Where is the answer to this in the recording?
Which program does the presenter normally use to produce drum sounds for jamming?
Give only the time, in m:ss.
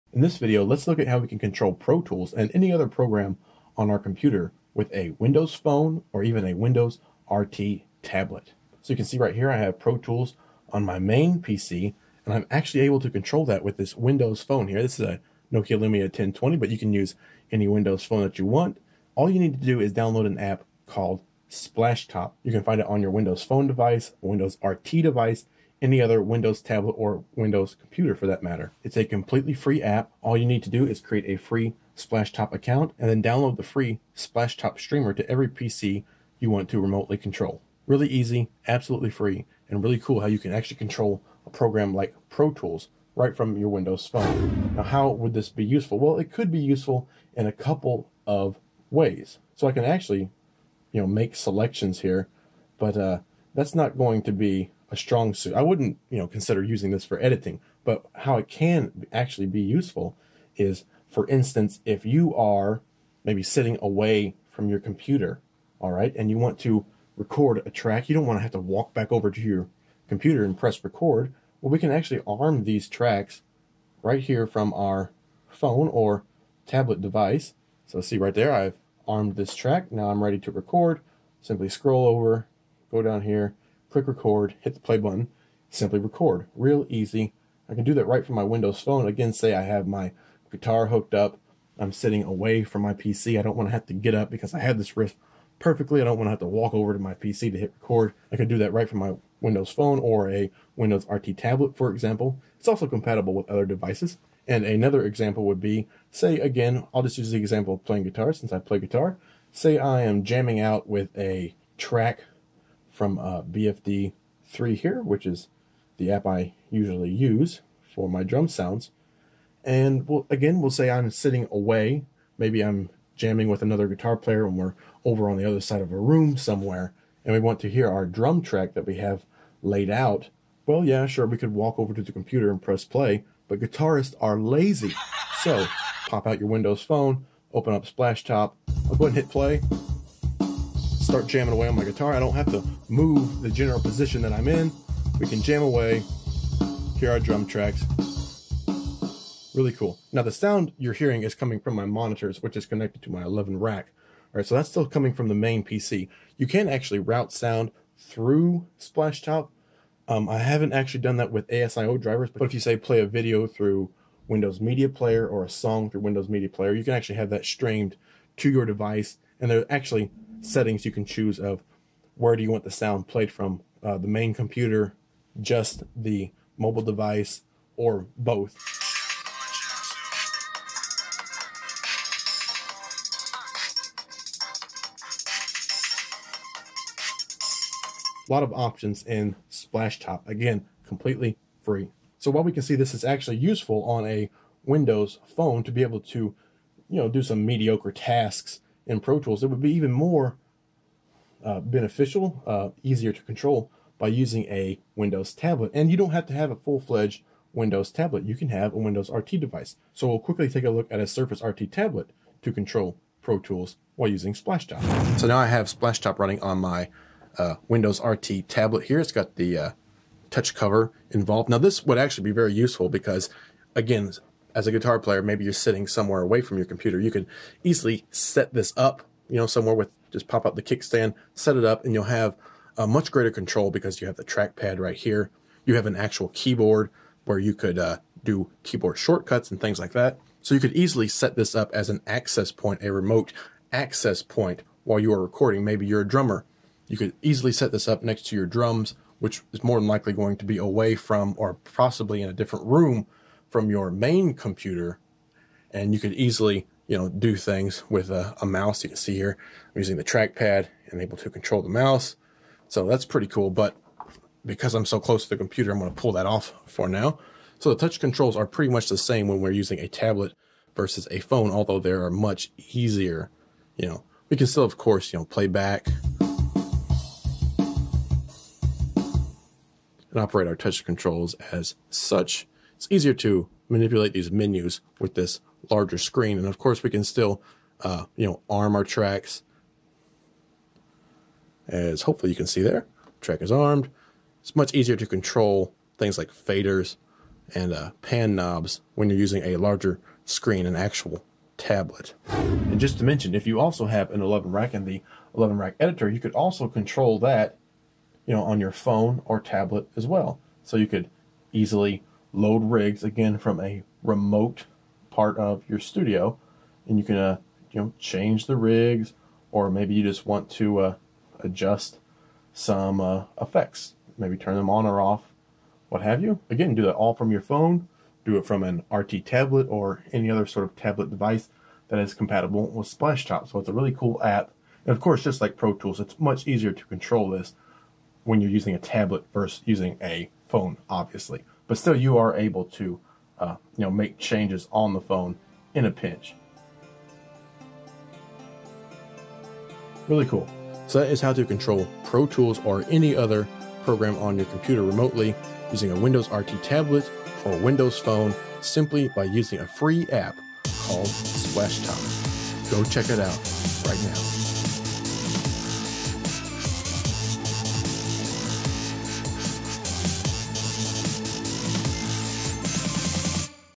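1:53.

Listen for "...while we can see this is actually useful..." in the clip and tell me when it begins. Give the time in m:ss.
3:12.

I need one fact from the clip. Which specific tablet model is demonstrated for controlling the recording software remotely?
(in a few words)
Surface RT.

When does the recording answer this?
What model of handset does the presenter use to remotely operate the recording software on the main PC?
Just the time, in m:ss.
0:15.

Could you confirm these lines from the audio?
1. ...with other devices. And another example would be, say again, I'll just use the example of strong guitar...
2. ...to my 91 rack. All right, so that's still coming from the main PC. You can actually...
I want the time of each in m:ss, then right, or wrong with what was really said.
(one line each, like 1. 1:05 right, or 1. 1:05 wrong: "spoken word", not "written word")
1. 1:43 wrong: "playing", not "strong"
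2. 2:33 wrong: "11", not "91".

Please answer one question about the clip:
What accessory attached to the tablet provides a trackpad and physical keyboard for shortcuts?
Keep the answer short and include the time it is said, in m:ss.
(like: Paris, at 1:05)
touch cover, at 3:40.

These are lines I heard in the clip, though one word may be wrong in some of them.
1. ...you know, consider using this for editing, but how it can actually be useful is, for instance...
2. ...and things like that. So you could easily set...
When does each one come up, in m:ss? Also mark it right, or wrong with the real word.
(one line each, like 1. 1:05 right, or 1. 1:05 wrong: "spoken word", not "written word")
1. 0:56 right
2. 3:59 right.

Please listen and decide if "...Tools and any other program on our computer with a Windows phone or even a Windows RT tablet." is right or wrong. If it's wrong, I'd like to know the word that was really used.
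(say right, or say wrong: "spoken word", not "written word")
right.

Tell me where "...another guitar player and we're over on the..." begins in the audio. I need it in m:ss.
2:03.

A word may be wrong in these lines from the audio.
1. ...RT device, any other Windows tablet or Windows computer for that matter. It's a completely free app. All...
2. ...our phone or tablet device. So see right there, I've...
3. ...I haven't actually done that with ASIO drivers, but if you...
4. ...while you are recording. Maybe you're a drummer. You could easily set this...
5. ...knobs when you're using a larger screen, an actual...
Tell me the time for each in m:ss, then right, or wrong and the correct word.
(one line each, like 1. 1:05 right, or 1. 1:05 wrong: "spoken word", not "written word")
1. 0:24 right
2. 1:14 right
3. 2:40 right
4. 4:04 right
5. 4:58 right.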